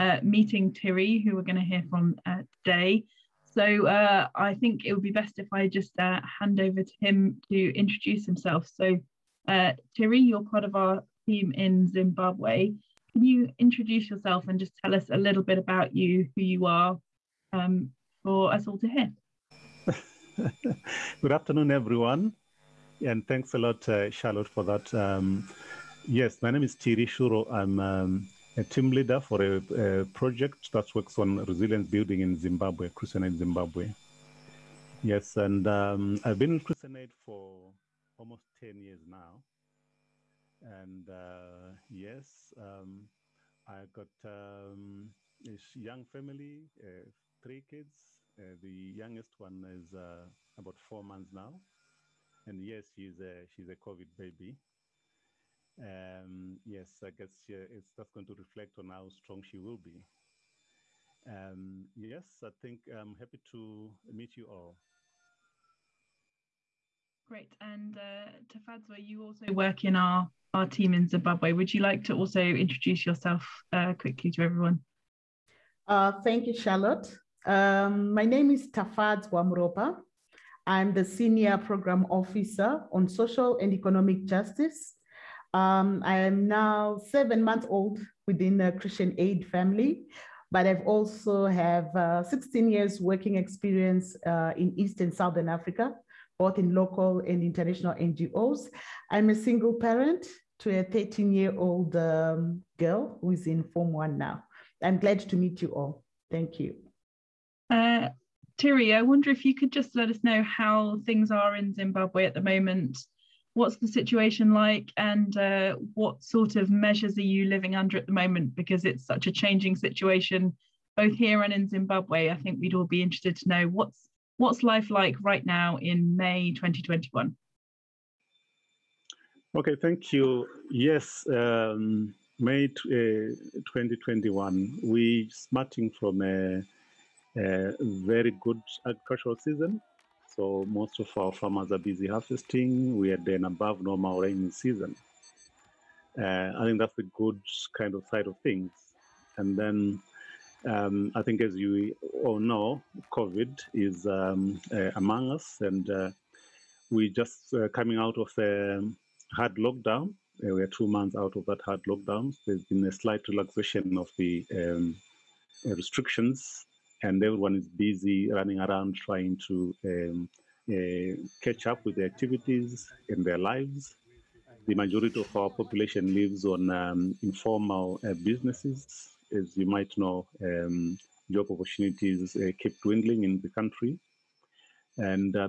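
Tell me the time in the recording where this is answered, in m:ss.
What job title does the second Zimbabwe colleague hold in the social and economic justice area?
1:21.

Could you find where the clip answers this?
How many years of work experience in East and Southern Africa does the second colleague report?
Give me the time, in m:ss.
1:32.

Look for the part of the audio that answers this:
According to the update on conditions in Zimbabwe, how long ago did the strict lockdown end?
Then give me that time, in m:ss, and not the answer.
2:40.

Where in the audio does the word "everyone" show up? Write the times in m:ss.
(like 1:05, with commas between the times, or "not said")
0:21, 1:14, 2:47.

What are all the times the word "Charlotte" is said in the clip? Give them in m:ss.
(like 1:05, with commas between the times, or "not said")
0:24, 1:16.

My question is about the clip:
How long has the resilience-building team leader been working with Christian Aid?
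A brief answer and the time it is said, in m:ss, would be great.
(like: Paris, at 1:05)
almost 10 years, at 0:38.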